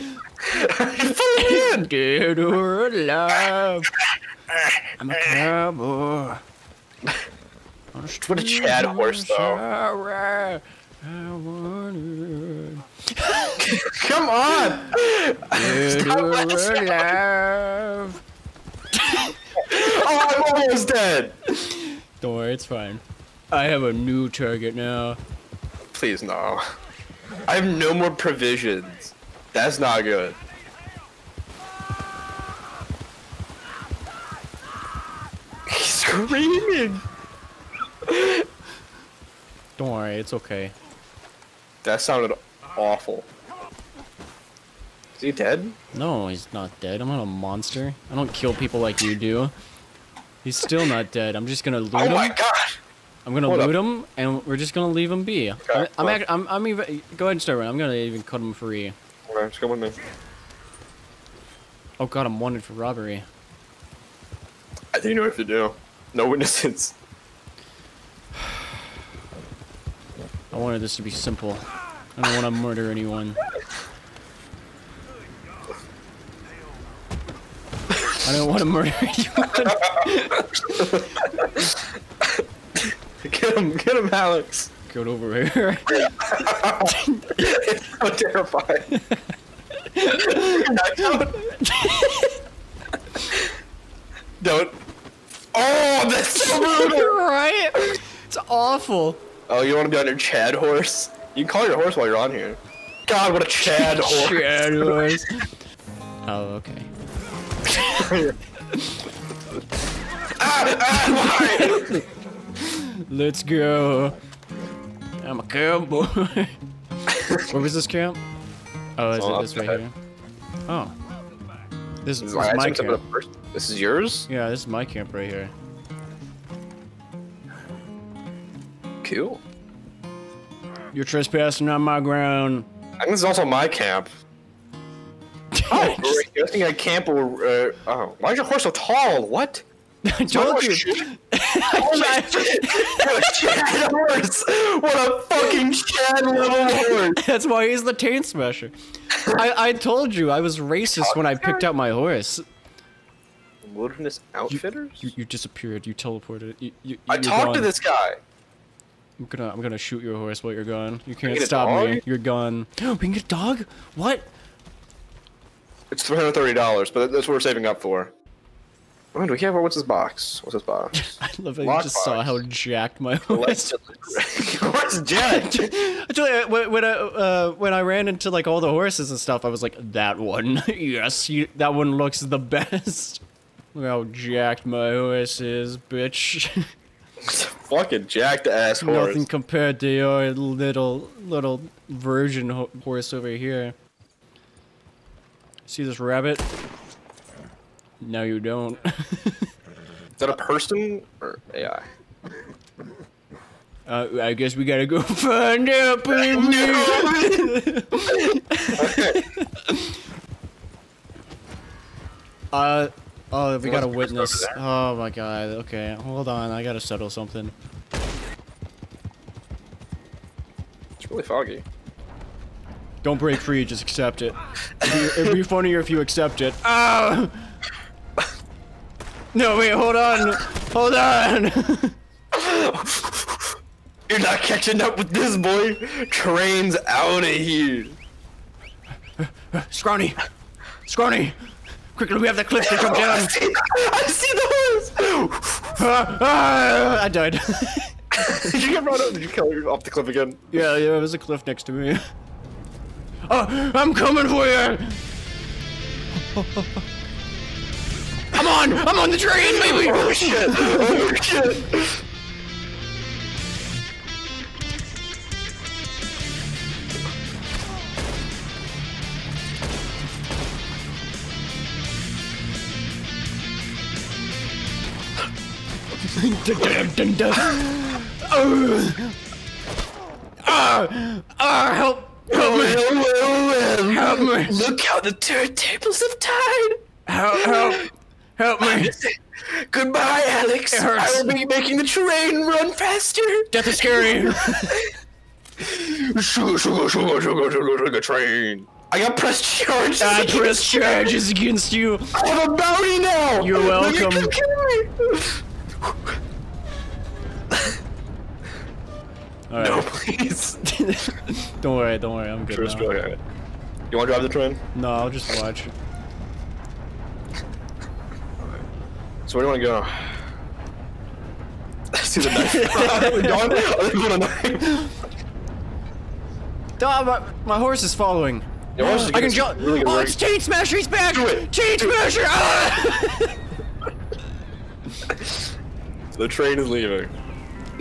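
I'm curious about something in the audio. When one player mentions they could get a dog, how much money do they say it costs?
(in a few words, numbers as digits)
$330.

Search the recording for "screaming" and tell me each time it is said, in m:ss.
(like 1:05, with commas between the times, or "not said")
0:35.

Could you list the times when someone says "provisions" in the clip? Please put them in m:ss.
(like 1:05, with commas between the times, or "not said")
0:28.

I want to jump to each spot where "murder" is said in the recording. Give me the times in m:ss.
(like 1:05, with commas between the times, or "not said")
1:12, 1:18.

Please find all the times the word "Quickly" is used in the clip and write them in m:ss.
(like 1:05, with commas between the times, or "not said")
4:01.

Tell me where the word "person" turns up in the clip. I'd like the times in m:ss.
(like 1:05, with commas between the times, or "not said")
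3:20.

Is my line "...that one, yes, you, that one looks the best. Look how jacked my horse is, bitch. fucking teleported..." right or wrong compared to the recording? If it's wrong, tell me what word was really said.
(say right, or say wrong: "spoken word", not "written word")
wrong: "jacked", not "teleported".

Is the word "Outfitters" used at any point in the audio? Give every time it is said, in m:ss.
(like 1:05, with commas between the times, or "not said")
2:34.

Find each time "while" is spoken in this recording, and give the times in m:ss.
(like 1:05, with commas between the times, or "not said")
1:41, 2:40.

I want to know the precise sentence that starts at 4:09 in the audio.
Did you kill off the cliff again?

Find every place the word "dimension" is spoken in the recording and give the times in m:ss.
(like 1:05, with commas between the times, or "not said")
not said.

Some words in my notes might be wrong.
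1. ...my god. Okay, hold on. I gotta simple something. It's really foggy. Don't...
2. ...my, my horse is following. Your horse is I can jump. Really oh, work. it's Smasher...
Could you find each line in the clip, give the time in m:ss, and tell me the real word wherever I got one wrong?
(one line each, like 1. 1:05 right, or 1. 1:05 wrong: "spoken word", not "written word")
1. 3:34 wrong: "settle", not "simple"
2. 5:27 wrong: "Chain", not "Smasher".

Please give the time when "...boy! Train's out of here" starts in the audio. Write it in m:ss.
3:55.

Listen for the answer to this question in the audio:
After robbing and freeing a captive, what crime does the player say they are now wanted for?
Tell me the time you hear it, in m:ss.
1:02.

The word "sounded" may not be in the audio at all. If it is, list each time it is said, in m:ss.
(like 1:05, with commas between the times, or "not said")
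0:42.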